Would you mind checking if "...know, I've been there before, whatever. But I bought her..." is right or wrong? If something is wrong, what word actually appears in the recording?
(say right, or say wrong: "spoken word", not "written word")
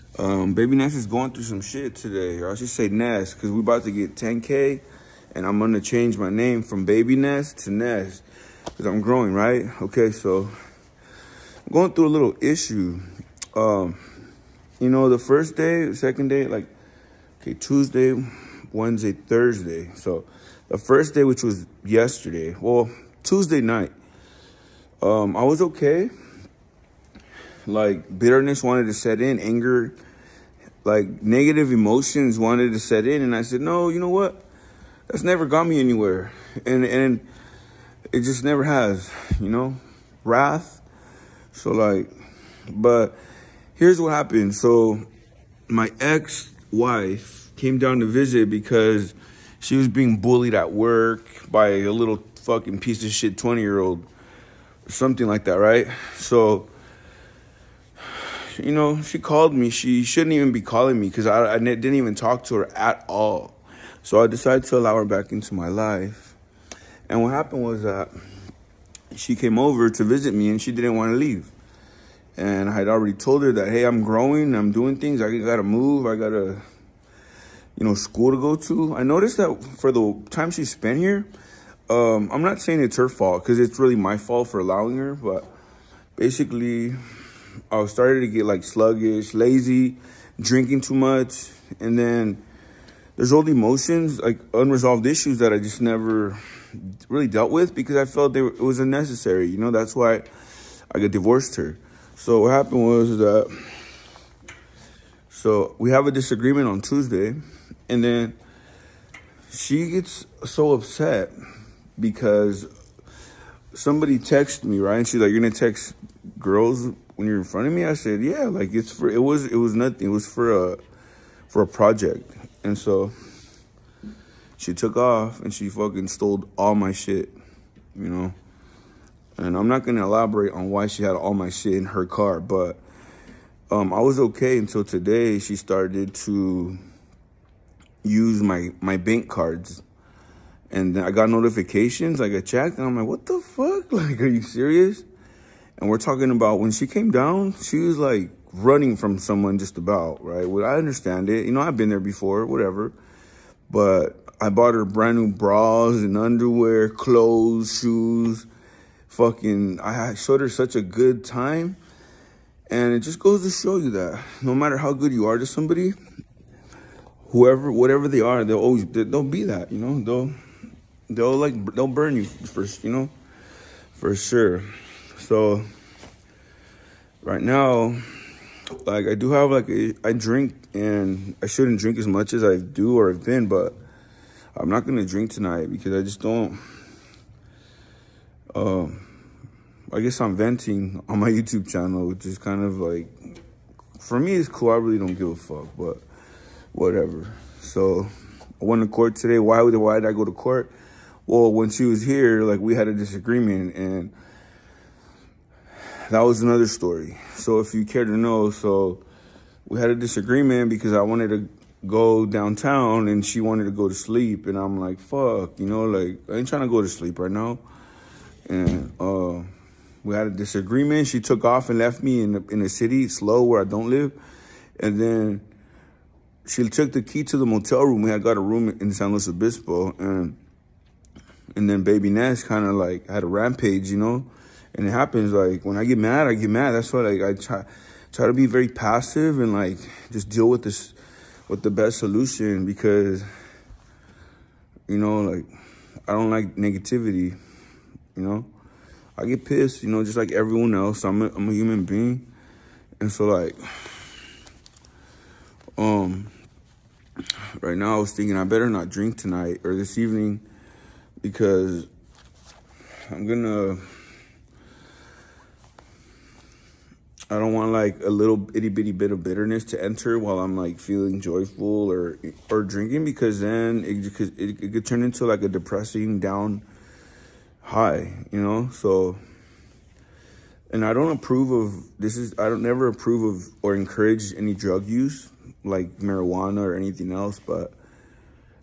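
right.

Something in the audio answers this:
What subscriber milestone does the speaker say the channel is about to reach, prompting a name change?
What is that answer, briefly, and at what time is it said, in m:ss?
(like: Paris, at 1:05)
10K, at 0:04.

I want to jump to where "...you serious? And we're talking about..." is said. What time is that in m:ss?
2:24.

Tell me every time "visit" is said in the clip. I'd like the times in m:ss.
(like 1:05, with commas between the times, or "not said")
0:48, 1:10.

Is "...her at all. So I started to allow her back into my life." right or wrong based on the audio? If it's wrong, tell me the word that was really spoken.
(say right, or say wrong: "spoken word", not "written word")
wrong: "decided", not "started".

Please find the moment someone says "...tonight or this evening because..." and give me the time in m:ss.
4:19.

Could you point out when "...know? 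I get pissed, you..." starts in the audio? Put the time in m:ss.
4:08.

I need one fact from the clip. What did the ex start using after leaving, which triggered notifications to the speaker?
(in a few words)
Bank cards.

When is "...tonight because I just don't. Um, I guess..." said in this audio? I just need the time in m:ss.
3:05.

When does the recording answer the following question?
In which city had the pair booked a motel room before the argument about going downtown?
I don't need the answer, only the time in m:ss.
3:48.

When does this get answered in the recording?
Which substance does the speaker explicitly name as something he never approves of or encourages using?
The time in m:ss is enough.
4:45.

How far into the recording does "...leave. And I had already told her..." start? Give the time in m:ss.
1:11.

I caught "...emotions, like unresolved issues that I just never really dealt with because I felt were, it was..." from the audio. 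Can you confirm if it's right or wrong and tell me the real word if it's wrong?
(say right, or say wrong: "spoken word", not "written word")
right.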